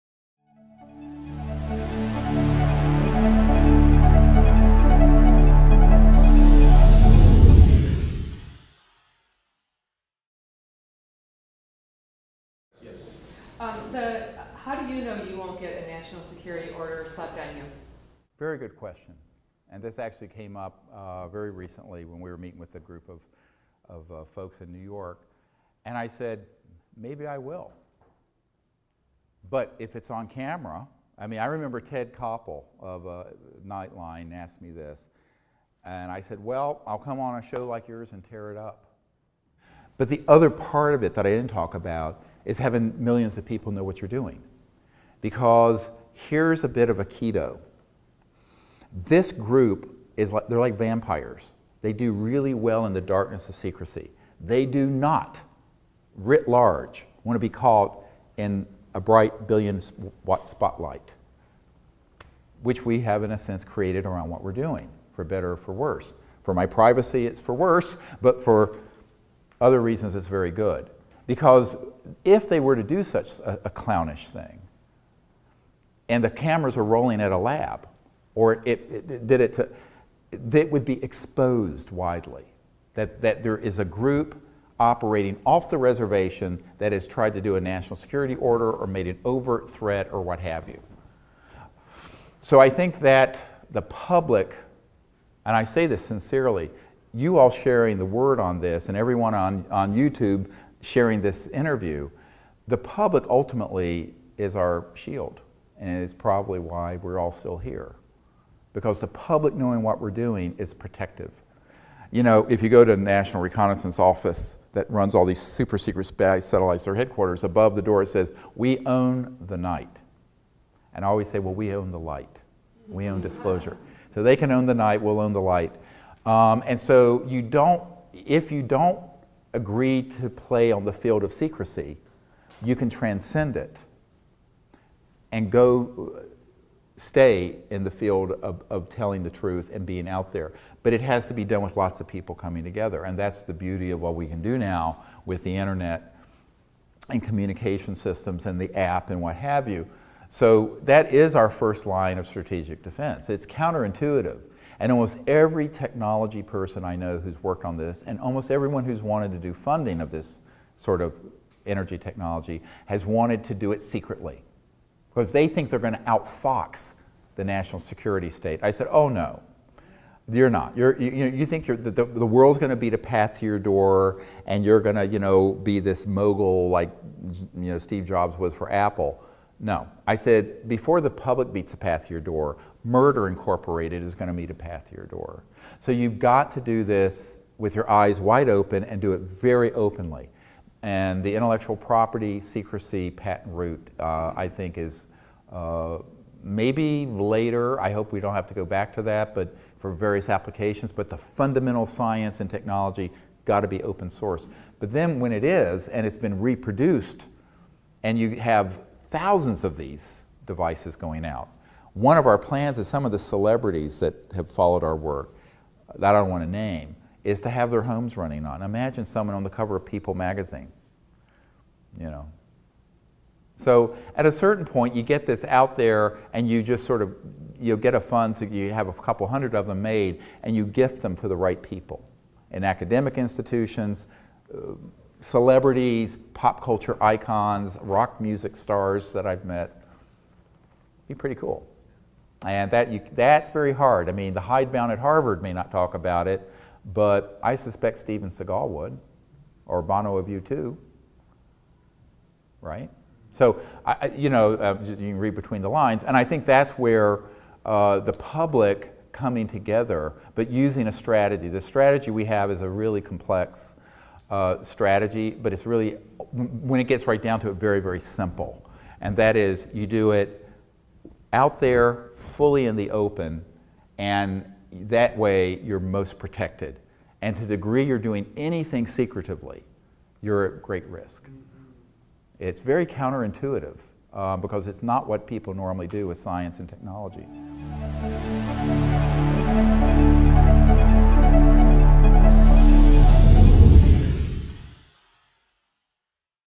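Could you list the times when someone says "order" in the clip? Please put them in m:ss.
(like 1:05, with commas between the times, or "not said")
0:16, 1:28.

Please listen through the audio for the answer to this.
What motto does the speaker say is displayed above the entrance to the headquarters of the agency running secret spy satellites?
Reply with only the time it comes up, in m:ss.
1:58.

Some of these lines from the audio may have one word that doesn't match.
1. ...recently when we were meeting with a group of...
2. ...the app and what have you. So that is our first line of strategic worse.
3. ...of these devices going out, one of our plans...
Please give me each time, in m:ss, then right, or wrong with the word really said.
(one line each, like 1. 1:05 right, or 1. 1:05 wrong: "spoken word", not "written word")
1. 0:21 right
2. 2:28 wrong: "defense", not "worse"
3. 3:29 right.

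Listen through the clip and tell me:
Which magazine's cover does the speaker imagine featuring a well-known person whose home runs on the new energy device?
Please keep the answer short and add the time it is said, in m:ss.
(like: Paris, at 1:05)
People magazine, at 3:39.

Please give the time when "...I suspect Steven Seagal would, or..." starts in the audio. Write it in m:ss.
4:07.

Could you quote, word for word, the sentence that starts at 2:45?
Because they think they're going to outfox the national security state.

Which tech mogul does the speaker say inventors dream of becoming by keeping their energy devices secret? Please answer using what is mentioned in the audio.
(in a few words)
Steve Jobs.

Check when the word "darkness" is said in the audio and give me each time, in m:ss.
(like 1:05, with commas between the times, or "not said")
0:53.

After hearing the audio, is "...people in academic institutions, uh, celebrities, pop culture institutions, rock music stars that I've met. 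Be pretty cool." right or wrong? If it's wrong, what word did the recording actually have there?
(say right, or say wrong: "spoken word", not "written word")
wrong: "icons", not "institutions".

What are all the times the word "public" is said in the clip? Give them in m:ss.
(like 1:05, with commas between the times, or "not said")
1:33, 1:42, 1:49, 3:01, 4:18.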